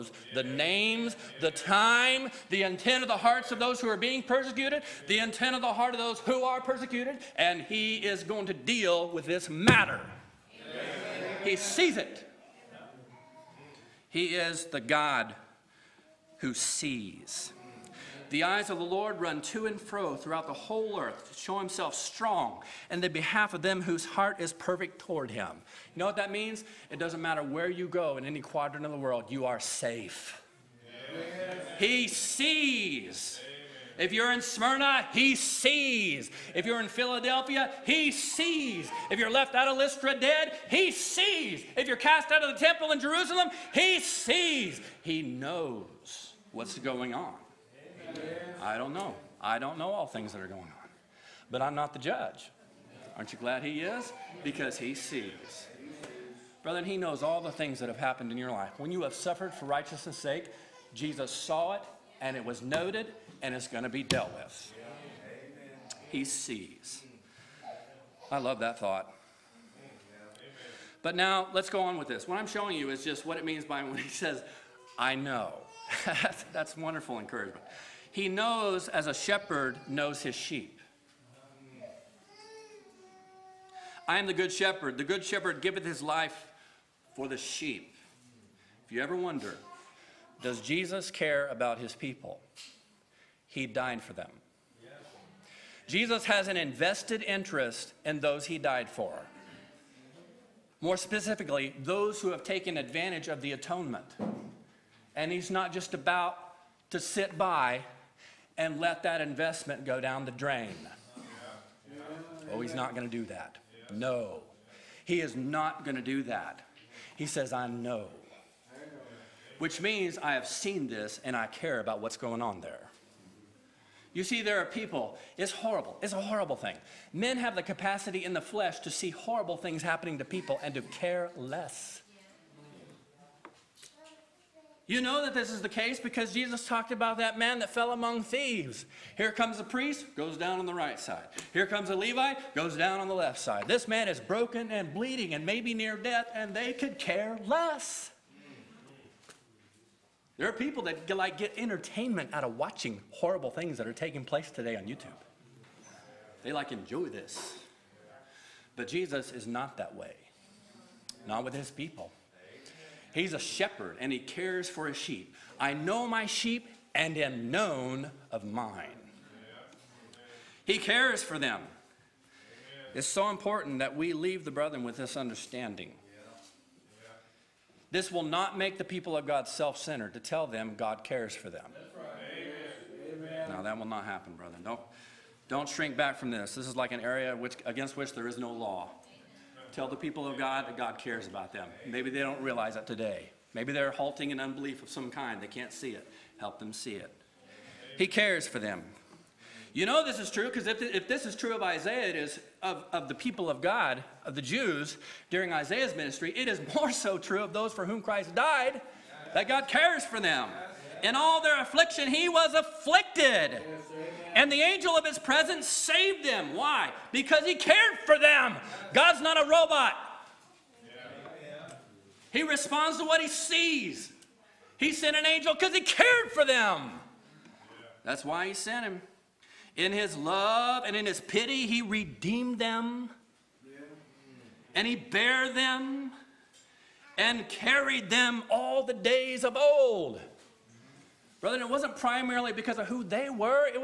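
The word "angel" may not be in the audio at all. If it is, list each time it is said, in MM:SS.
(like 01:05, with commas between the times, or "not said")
03:34, 03:45.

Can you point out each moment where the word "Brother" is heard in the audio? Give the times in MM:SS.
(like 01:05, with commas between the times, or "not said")
00:56, 04:01.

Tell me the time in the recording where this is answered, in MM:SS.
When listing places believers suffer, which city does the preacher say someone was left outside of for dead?
00:39.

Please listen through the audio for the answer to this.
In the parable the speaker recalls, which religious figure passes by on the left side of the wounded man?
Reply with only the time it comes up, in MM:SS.
02:21.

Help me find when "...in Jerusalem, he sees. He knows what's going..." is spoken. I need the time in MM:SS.
00:42.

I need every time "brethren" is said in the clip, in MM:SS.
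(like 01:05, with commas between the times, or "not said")
02:54, 03:04.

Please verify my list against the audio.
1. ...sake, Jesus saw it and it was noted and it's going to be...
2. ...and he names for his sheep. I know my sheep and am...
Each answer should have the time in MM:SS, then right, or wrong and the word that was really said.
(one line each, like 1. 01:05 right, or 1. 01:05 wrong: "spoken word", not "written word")
1. 01:00 right
2. 02:43 wrong: "cares", not "names".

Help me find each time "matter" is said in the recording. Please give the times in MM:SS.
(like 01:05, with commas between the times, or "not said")
00:09, 00:27.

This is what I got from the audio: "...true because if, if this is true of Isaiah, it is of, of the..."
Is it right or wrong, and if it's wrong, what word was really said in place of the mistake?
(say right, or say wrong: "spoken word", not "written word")
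right.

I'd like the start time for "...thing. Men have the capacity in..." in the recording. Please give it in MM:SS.
02:06.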